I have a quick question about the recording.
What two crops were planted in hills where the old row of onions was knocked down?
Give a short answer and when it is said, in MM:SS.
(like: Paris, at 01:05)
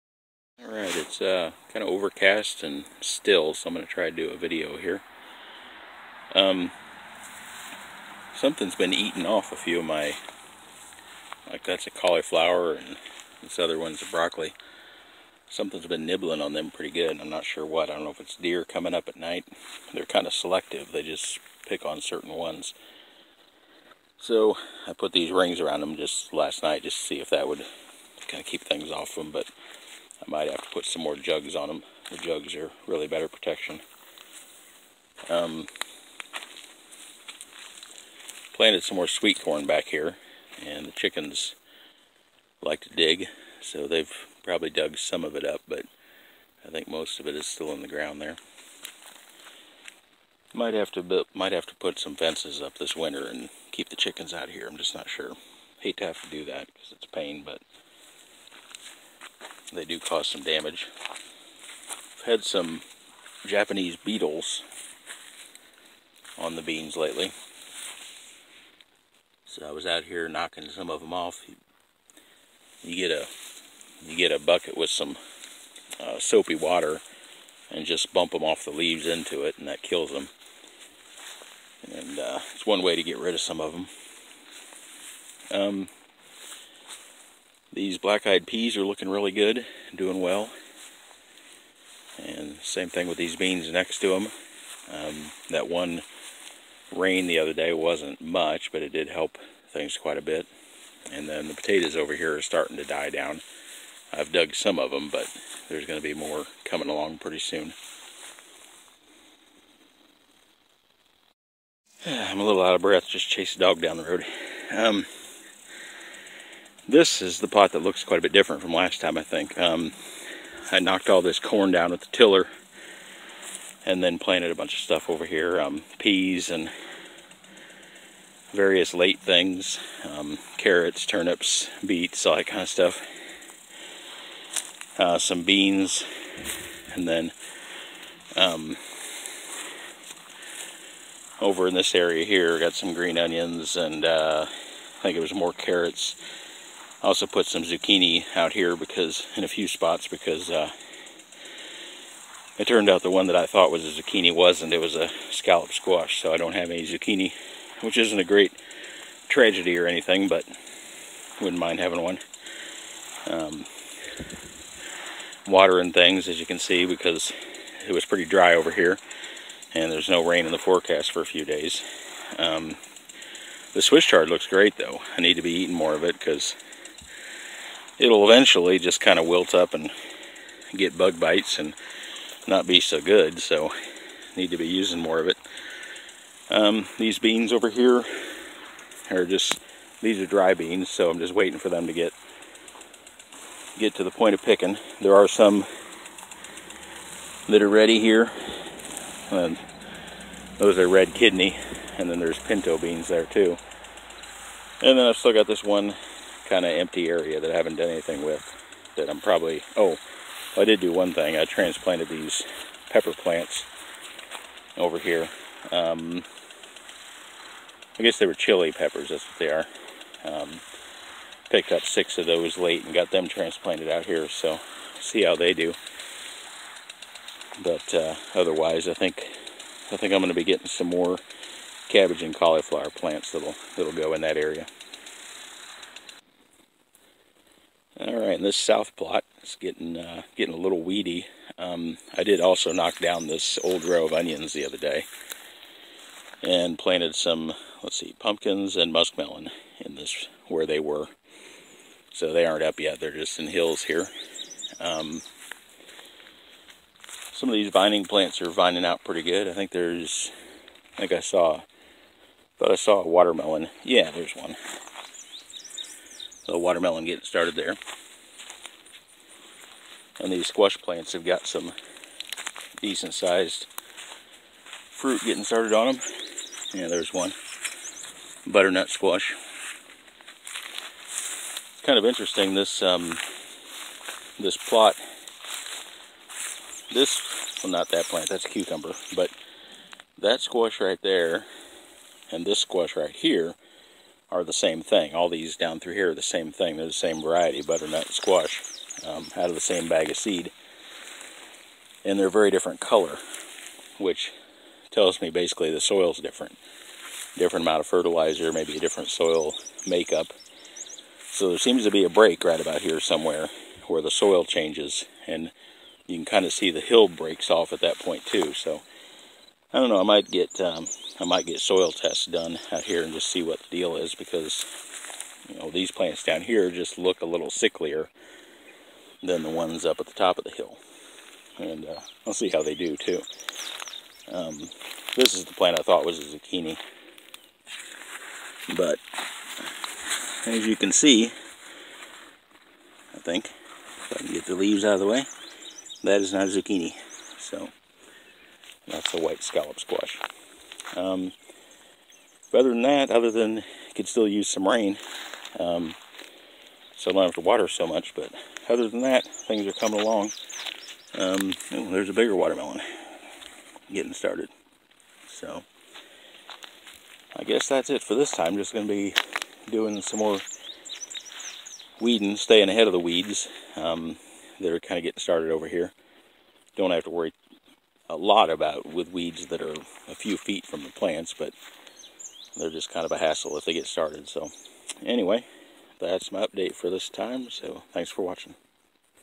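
pumpkins and muskmelon, at 04:08.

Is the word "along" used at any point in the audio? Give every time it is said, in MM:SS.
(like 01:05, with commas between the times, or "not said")
01:46, 06:00.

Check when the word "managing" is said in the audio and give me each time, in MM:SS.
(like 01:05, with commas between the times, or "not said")
not said.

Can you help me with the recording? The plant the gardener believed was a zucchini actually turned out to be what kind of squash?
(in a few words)
white scallop squash.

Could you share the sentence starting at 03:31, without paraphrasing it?
I transplanted these pepper plants over here.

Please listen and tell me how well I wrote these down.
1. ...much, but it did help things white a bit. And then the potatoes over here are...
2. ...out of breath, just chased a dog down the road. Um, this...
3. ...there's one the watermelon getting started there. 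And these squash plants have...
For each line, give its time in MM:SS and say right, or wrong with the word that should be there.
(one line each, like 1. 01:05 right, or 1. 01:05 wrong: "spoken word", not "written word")
1. 01:38 wrong: "quite", not "white"
2. 01:52 right
3. 04:24 right.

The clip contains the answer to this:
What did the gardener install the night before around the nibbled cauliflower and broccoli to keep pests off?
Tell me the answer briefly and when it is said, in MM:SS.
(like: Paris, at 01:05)
rings, at 00:25.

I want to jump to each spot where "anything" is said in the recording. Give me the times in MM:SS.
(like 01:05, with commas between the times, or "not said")
02:39, 03:27.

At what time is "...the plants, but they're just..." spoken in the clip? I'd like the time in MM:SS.
06:20.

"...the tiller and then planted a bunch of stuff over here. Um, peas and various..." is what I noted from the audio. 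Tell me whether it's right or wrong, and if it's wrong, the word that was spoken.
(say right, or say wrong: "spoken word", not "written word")
right.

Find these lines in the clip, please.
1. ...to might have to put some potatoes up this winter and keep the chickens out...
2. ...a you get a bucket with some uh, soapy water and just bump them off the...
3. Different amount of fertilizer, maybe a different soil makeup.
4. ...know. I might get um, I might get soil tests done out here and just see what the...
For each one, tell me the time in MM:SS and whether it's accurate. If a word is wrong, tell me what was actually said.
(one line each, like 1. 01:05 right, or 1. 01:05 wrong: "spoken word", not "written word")
1. 00:50 wrong: "fences", not "potatoes"
2. 01:13 right
3. 05:07 right
4. 05:19 right.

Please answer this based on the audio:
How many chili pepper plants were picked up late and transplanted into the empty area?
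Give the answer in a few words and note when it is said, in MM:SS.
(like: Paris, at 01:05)
6, at 03:41.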